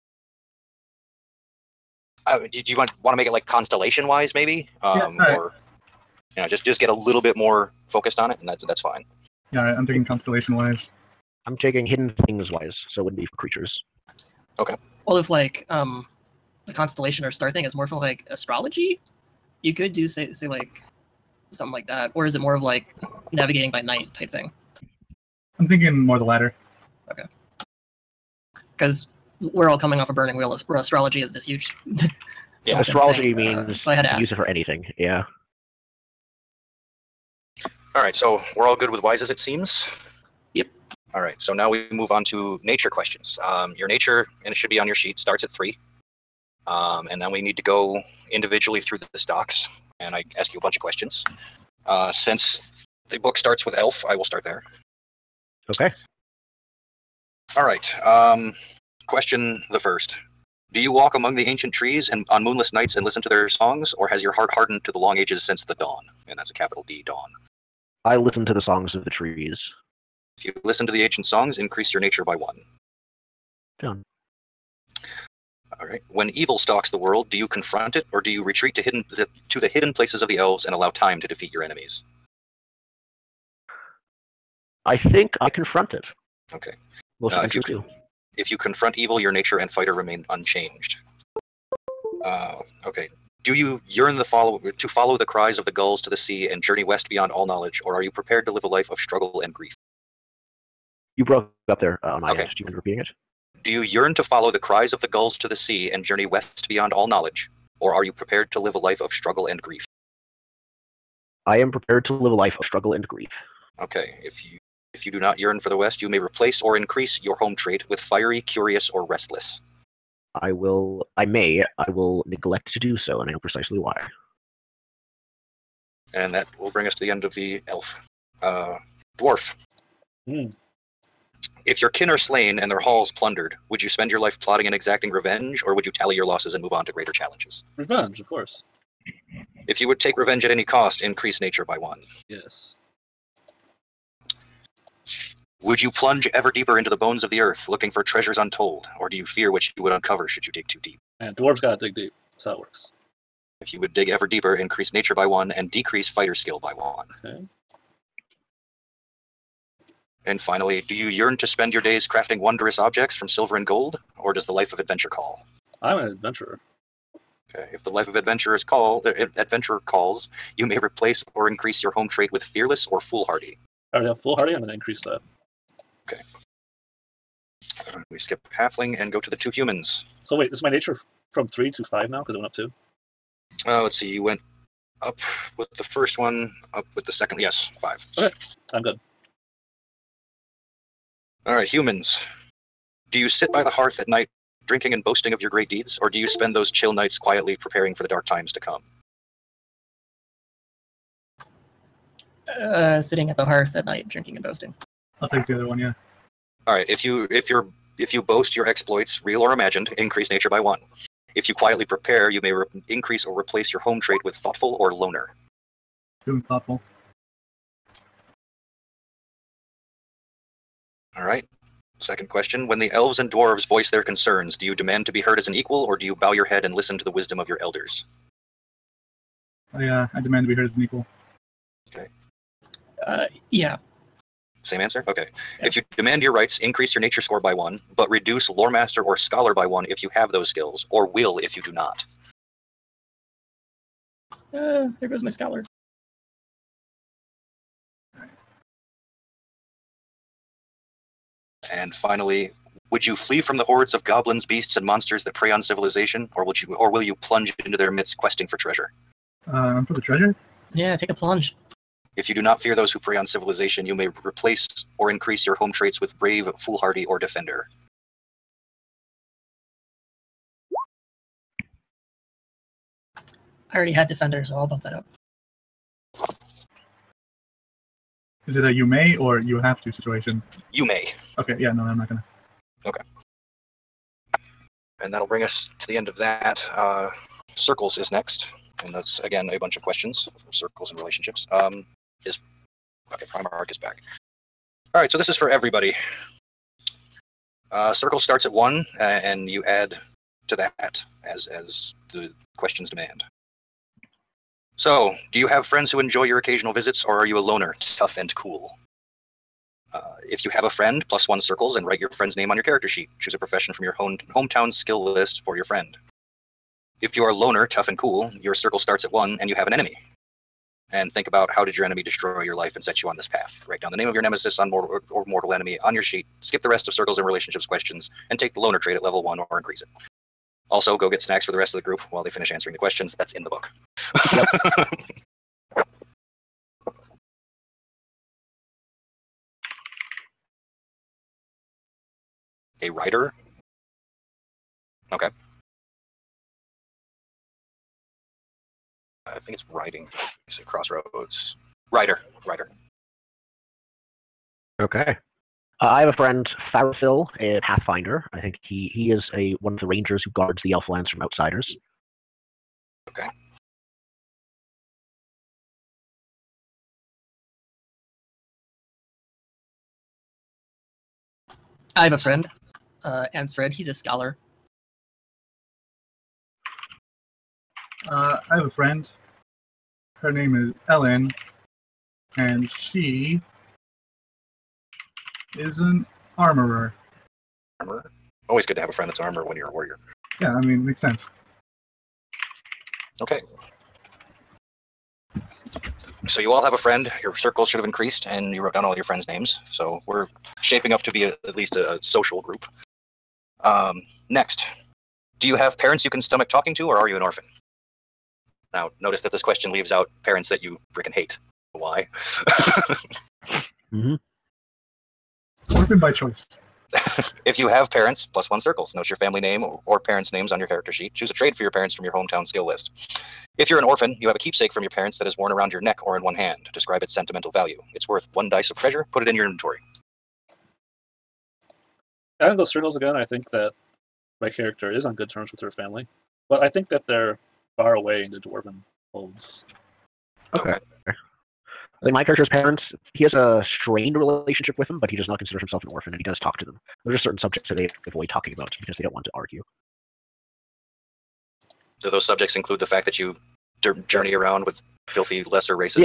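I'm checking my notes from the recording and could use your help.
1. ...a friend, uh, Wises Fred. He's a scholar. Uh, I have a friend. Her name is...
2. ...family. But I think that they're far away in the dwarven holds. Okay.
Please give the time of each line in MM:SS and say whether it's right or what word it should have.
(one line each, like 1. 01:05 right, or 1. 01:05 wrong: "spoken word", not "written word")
1. 06:12 wrong: "Ernst", not "Wises"
2. 07:15 right.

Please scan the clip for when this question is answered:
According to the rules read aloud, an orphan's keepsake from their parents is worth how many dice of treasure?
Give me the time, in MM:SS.
07:08.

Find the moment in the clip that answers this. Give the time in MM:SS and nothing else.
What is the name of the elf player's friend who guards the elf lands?
05:56.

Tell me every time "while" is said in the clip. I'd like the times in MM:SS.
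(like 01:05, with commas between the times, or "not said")
05:32.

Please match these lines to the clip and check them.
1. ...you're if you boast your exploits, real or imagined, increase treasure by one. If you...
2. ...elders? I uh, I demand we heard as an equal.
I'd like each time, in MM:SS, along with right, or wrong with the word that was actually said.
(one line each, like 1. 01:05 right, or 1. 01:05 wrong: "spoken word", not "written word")
1. 03:27 wrong: "nature", not "treasure"
2. 03:47 right.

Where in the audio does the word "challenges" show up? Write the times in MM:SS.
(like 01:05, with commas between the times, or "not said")
02:17.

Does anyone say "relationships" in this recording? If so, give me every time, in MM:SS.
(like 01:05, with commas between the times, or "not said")
04:50, 05:27, 07:24.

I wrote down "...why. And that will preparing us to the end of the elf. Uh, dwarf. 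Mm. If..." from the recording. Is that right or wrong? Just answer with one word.
wrong.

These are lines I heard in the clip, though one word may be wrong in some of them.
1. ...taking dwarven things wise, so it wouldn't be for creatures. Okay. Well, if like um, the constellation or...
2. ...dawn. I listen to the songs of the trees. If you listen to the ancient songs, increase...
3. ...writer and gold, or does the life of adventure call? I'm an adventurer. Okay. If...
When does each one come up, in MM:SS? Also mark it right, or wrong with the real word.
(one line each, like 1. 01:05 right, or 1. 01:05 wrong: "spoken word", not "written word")
1. 00:11 wrong: "hidden", not "dwarven"
2. 01:07 right
3. 02:43 wrong: "silver", not "writer".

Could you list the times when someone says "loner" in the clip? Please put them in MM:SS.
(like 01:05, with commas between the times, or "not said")
03:34, 05:07, 05:17, 05:28.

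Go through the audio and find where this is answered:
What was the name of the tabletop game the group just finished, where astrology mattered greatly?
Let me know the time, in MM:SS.
00:30.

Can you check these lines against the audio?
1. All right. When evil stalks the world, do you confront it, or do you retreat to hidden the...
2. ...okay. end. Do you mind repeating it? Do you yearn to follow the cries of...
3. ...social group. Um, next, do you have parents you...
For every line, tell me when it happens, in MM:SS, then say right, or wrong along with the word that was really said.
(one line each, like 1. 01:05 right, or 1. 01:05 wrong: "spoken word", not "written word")
1. 01:15 right
2. 01:42 right
3. 06:42 right.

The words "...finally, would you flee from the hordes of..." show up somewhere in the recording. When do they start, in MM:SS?
04:11.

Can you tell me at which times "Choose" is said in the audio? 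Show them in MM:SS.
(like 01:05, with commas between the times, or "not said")
05:13, 07:01.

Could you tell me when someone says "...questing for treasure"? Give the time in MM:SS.
04:18.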